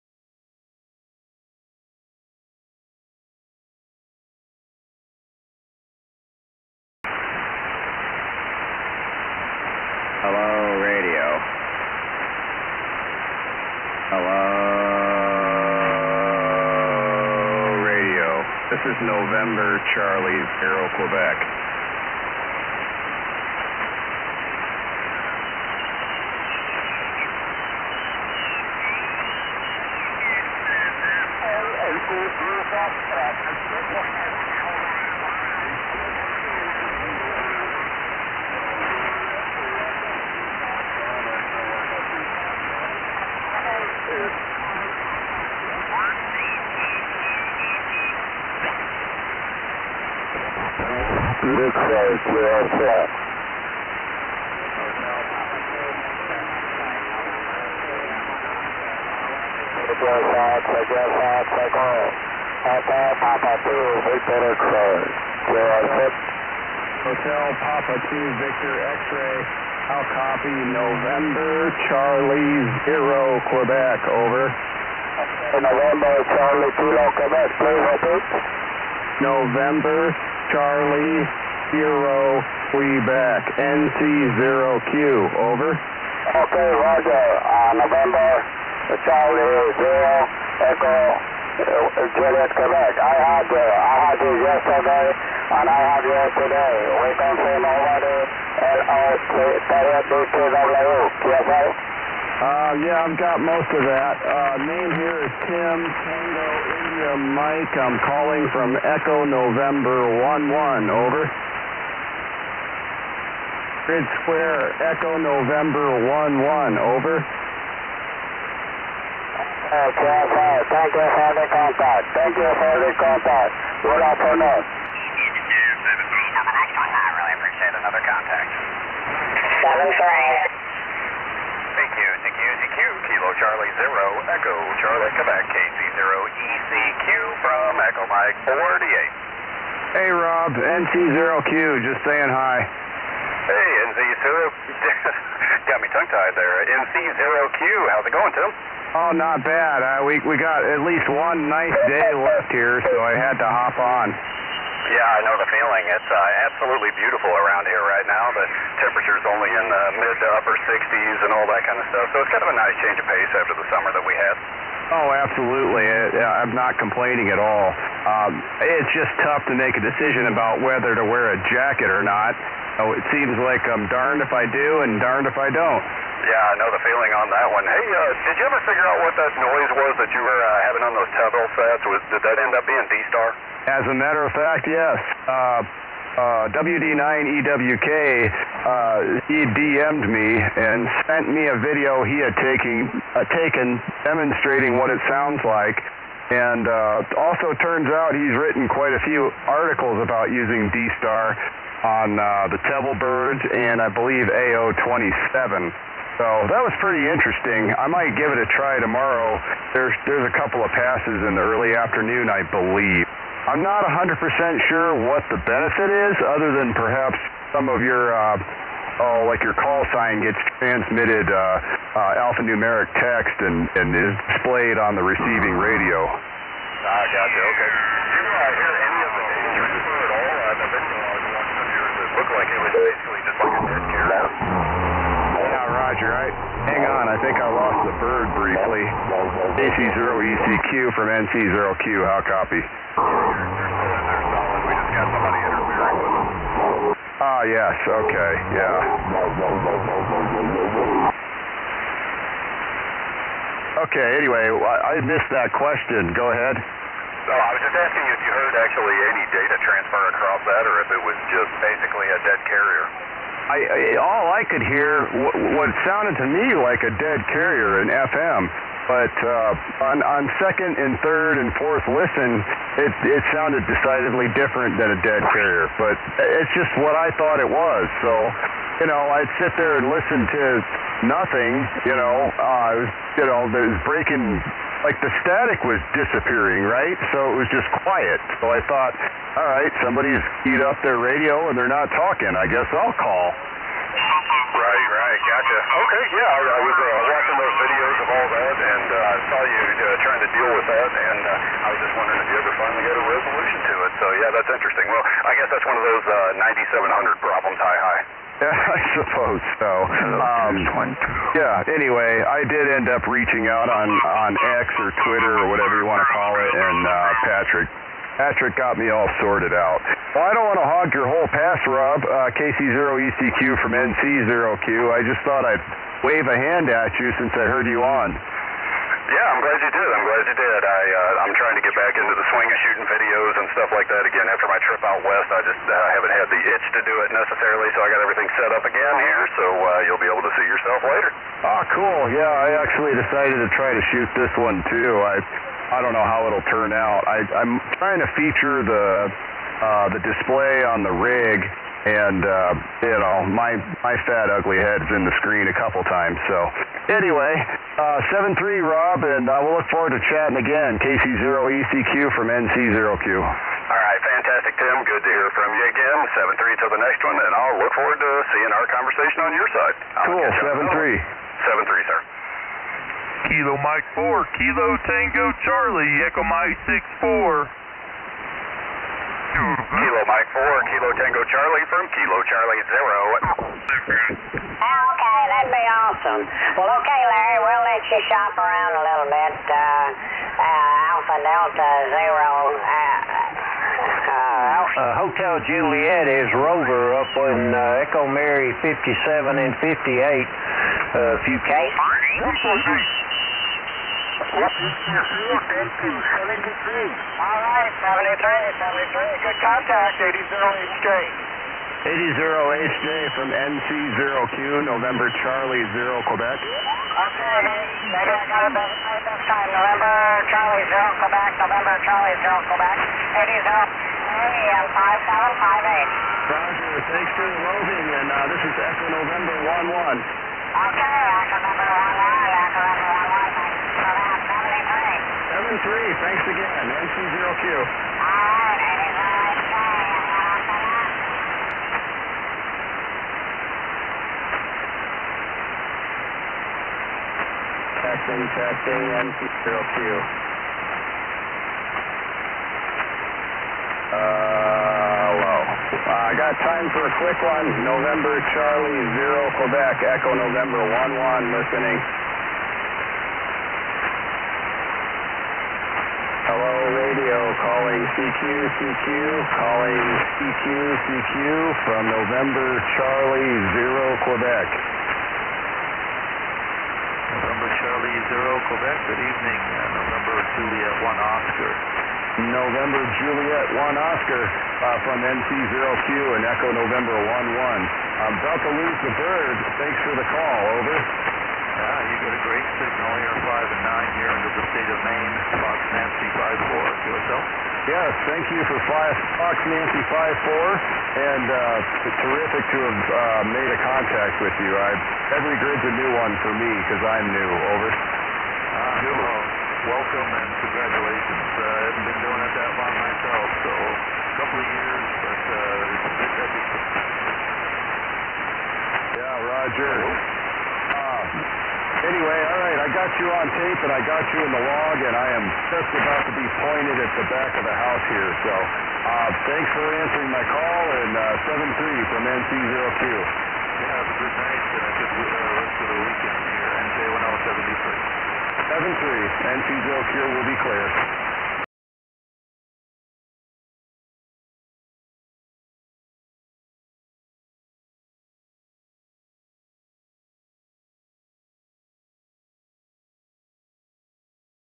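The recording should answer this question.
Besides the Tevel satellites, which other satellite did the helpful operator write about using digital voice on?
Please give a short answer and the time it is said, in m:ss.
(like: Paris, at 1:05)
AO27, at 3:24.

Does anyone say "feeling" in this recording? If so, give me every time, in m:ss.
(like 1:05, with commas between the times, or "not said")
2:35, 2:56.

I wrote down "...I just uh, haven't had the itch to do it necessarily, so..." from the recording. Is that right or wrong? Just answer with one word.
right.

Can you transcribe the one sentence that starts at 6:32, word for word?
Uh, uh Hotel Juliet is Rover up in uh, Echo Mary 57 and 58.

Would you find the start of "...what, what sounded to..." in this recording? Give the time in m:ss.
4:25.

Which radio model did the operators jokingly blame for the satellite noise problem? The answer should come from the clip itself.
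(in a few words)
9700.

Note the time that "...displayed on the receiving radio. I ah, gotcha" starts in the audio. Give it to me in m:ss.
3:44.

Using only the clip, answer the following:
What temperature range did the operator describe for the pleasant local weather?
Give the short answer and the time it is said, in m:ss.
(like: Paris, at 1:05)
mid to upper 60s, at 2:40.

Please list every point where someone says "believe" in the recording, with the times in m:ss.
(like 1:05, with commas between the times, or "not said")
3:23, 3:32.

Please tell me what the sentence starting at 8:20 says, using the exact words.
And uh, it's terrific to have uh, made a contact with you.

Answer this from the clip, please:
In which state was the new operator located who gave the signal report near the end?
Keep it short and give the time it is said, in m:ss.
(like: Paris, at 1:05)
Maine, at 8:14.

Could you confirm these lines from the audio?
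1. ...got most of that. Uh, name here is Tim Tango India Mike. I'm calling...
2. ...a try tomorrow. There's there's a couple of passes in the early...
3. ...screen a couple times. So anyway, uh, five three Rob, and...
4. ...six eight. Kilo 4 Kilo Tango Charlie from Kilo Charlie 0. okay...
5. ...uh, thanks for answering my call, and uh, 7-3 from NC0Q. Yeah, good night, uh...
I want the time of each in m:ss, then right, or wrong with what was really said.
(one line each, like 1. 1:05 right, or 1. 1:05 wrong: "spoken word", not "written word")
1. 1:43 right
2. 3:28 right
3. 5:55 wrong: "seven", not "five"
4. 6:16 wrong: "four", not "eight"
5. 8:48 right.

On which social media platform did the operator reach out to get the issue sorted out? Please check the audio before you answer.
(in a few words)
X.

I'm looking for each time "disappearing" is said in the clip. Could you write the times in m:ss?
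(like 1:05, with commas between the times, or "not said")
4:45.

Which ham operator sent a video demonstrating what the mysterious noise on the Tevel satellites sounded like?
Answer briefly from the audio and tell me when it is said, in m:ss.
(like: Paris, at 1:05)
WD9EWK, at 3:06.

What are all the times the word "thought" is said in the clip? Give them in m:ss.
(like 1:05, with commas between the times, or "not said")
4:37, 4:48, 5:25.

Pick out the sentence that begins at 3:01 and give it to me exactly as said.
Was, did that end up being D-Star?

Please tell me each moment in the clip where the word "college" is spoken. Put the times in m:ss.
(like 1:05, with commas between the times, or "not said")
not said.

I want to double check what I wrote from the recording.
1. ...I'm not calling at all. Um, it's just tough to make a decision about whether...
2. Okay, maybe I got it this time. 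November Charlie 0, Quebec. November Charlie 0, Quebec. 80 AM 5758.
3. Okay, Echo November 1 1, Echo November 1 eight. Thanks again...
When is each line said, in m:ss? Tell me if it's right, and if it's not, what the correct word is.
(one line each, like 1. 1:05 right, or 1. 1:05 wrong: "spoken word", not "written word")
1. 2:46 wrong: "complaining", not "calling"
2. 6:56 right
3. 7:09 wrong: "three", not "eight".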